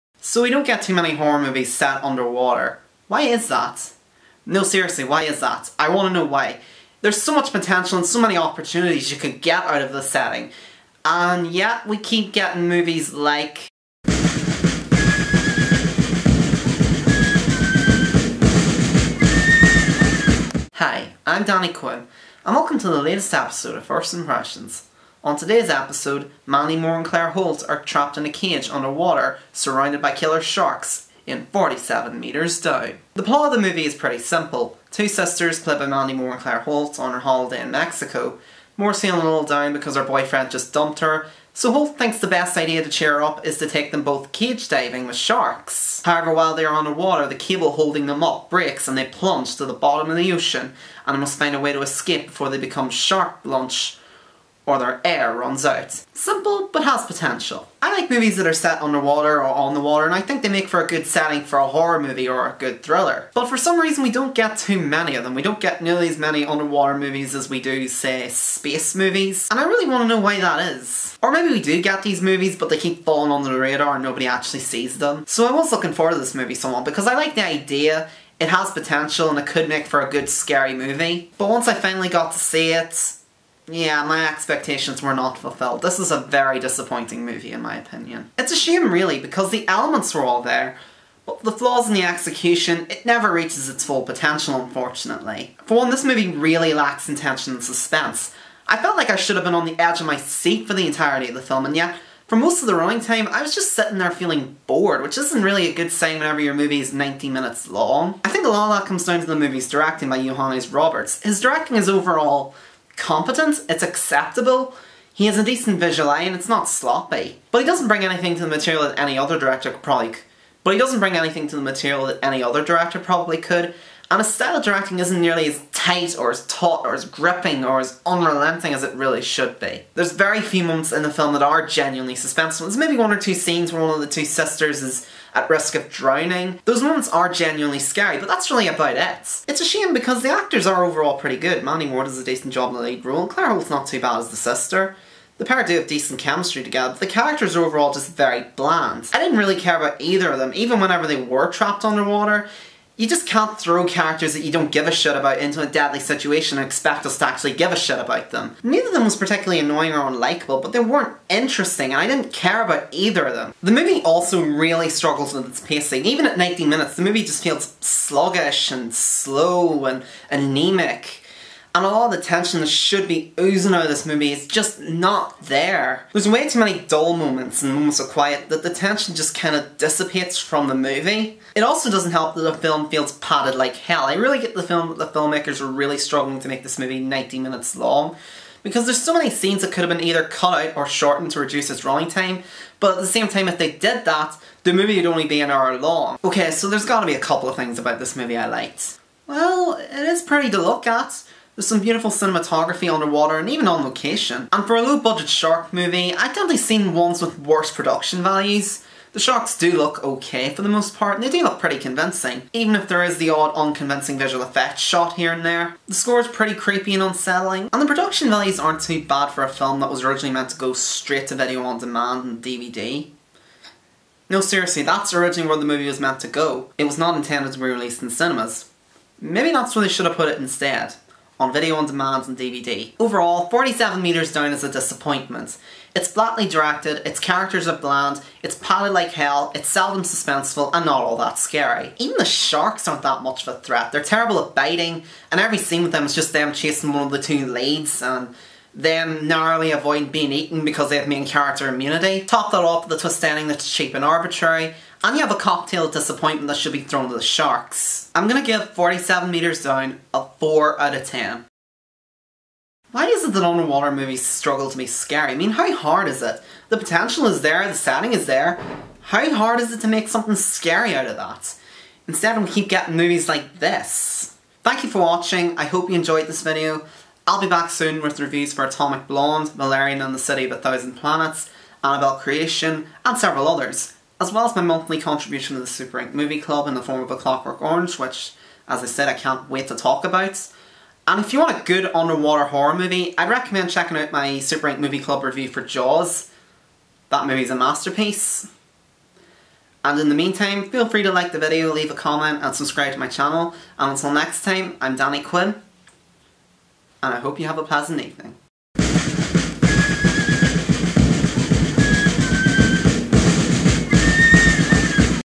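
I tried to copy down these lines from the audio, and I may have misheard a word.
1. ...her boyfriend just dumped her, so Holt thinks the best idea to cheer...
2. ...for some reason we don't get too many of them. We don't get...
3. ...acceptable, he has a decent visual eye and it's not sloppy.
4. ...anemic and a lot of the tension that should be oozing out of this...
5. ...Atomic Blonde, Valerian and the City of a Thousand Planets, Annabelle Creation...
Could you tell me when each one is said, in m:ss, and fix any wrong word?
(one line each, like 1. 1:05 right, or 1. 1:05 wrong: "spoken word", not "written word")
1. 0:39 right
2. 1:03 right
3. 1:53 right
4. 2:50 right
5. 4:38 right.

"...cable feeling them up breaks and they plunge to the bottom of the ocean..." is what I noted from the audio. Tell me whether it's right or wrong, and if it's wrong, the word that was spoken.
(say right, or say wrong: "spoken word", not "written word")
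wrong: "holding", not "feeling".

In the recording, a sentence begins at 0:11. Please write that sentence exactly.
And yet we keep getting movies like...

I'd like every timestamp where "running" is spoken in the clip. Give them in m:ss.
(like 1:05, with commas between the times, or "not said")
1:42, 3:11.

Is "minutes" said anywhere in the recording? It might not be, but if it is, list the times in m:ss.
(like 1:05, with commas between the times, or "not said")
1:47, 2:46, 3:07.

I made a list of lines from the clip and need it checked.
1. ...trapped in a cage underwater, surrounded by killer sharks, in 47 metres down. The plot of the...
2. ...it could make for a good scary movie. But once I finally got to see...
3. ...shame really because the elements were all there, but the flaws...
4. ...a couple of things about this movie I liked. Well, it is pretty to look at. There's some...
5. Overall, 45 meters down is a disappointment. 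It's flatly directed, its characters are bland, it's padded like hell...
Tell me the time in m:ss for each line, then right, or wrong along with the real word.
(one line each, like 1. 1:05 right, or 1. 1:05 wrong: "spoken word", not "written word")
1. 0:27 right
2. 1:19 right
3. 1:28 right
4. 3:17 right
5. 3:52 wrong: "47", not "45".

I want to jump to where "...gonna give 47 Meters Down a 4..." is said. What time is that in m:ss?
4:18.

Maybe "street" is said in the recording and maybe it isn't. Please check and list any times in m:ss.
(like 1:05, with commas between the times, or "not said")
not said.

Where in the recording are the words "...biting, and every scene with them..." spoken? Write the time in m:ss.
4:04.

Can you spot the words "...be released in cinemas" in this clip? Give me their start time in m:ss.
3:47.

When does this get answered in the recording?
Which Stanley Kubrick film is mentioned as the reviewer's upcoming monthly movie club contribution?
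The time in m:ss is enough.
4:47.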